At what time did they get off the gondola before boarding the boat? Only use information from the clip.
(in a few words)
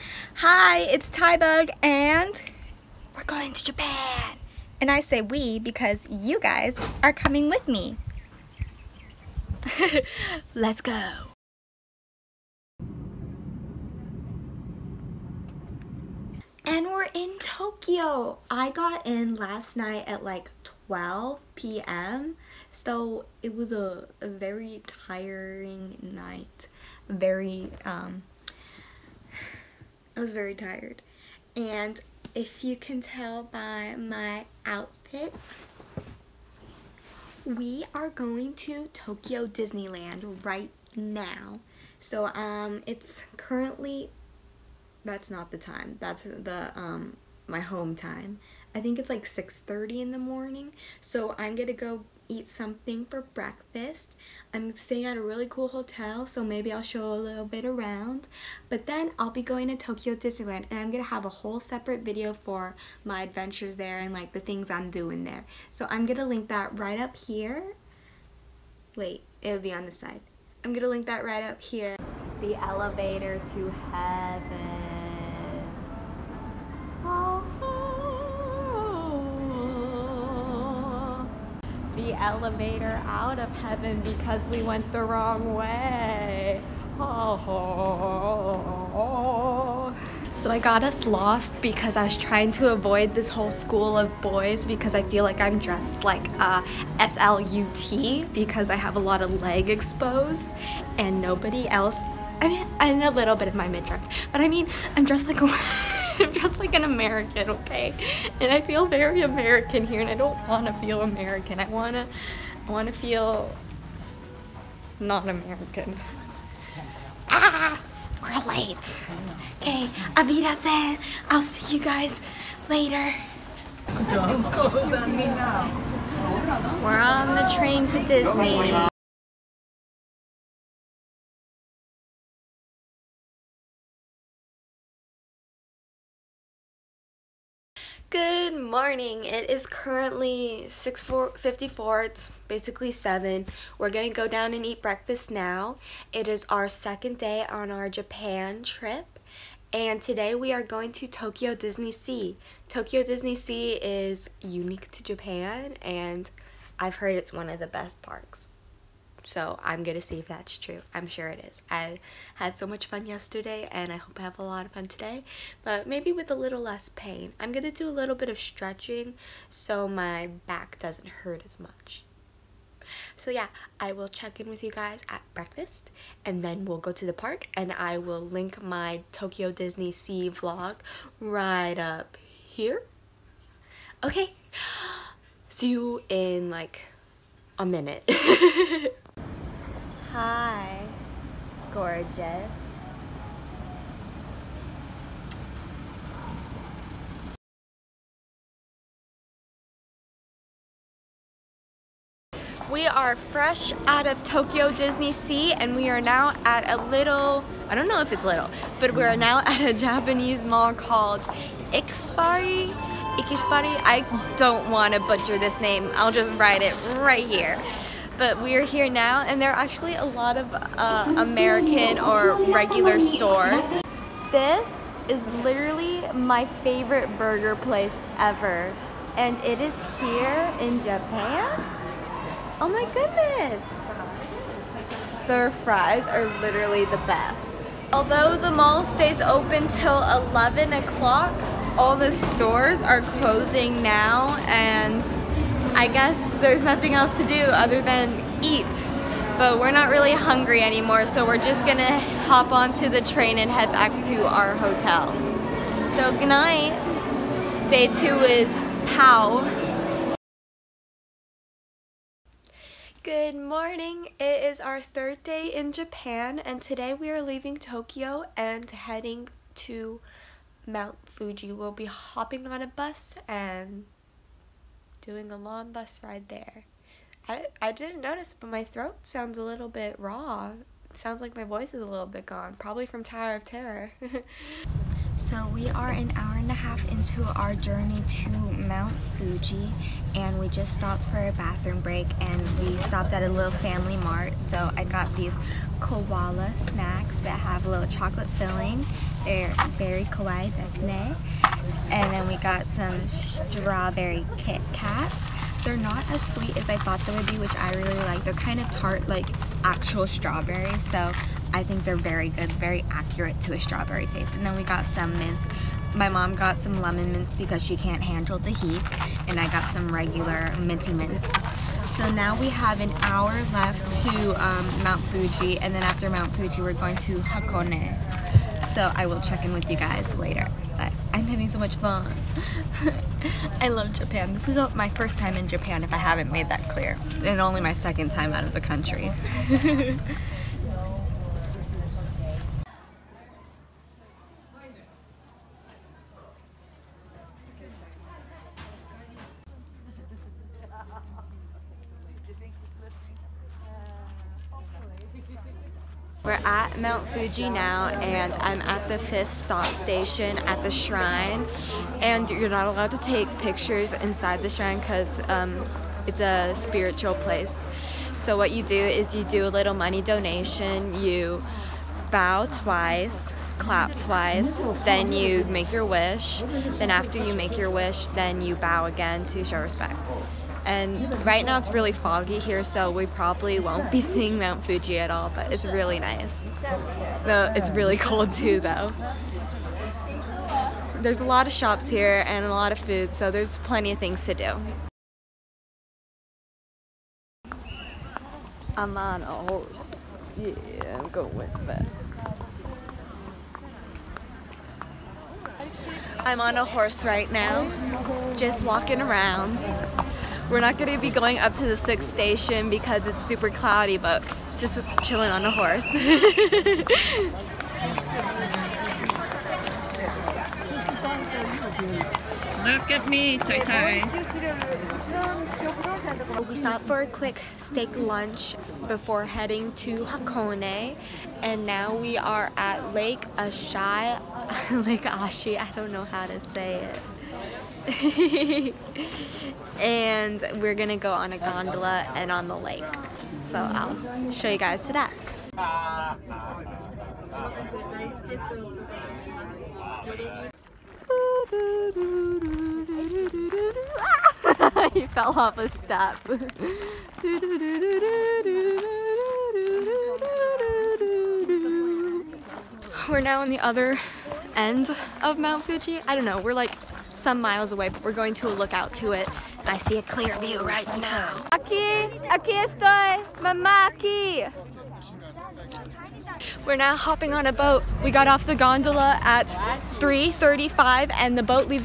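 3:35.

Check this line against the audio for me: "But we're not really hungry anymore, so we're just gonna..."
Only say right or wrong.
right.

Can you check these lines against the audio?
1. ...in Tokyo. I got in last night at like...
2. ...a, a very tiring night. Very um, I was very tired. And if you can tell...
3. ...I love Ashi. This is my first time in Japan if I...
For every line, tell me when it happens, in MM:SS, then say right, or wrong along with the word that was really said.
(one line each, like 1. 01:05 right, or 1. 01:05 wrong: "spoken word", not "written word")
1. 00:17 right
2. 00:23 right
3. 05:33 wrong: "Japan", not "Ashi".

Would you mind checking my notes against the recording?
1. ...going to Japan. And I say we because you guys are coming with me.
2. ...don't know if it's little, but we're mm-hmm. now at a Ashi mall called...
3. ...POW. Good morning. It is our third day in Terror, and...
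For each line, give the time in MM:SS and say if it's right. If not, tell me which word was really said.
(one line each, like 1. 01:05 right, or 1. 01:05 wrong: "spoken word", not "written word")
1. 00:03 right
2. 03:27 wrong: "Japanese", not "Ashi"
3. 04:18 wrong: "Japan", not "Terror".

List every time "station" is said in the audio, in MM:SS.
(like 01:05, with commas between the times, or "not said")
05:59, 06:52.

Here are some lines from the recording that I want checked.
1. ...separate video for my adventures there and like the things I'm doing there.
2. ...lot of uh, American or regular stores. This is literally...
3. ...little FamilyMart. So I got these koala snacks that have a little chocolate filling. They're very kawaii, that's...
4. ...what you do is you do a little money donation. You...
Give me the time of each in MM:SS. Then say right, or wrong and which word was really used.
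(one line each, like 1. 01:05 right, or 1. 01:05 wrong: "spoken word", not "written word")
1. 01:01 right
2. 03:40 right
3. 04:53 right
4. 06:08 right.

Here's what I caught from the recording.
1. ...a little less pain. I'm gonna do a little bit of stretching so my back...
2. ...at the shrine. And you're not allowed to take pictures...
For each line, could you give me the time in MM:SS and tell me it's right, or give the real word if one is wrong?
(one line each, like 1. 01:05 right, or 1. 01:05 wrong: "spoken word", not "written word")
1. 02:46 right
2. 06:00 right.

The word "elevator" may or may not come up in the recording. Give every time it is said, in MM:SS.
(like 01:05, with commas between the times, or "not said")
01:12, 01:22.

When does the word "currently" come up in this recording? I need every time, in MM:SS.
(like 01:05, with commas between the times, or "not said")
00:43, 02:19.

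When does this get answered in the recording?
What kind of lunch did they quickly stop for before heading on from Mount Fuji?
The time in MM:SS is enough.
07:07.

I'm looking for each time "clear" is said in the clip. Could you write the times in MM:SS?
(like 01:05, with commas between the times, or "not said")
05:36, 07:50.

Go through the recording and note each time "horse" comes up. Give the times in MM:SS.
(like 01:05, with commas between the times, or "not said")
06:39, 06:46, 06:55.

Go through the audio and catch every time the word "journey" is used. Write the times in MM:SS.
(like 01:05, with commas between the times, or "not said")
04:47.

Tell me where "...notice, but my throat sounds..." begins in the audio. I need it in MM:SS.
04:38.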